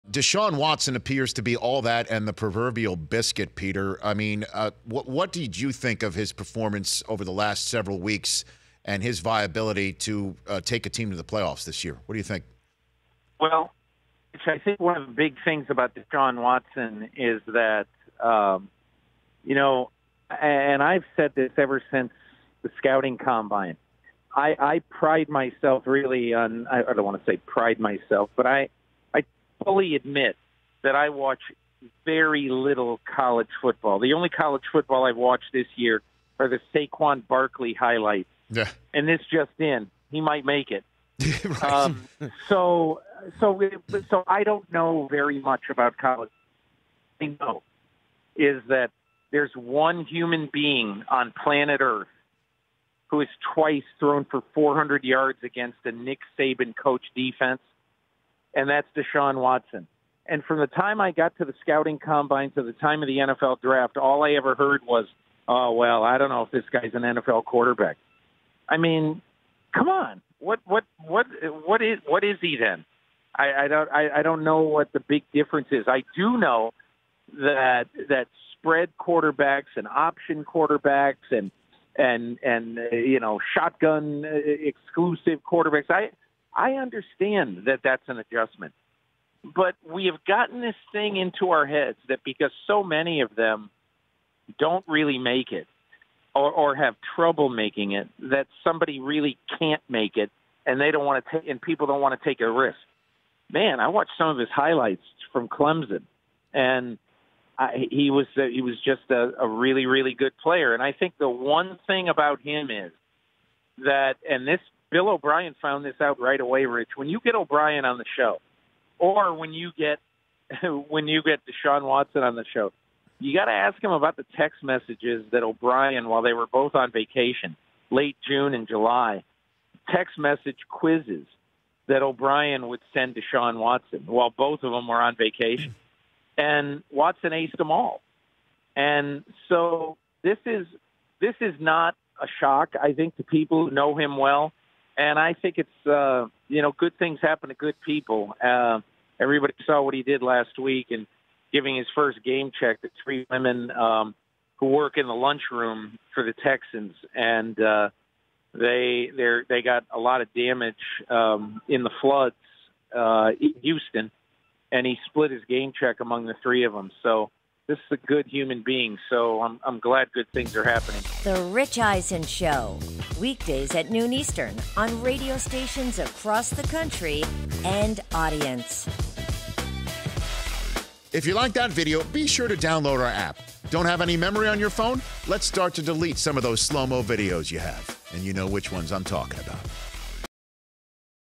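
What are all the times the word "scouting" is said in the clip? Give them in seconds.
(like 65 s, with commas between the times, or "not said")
22 s, 61 s.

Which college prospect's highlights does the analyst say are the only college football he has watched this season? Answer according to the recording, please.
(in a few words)
Saquon Barkley.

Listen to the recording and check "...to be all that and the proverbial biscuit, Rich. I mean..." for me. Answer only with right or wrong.
wrong.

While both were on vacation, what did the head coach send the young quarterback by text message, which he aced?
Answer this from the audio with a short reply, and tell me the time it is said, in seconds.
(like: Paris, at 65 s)
Quizzes, at 130 s.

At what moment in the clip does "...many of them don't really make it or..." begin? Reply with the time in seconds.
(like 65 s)
92 s.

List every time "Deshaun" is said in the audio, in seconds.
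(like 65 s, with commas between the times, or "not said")
0 s, 15 s, 58 s, 121 s.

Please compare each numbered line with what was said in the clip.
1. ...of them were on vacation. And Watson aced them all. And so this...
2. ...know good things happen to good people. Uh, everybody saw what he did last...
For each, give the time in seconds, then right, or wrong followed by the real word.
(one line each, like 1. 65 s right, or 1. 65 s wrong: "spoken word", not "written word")
1. 134 s right
2. 146 s right.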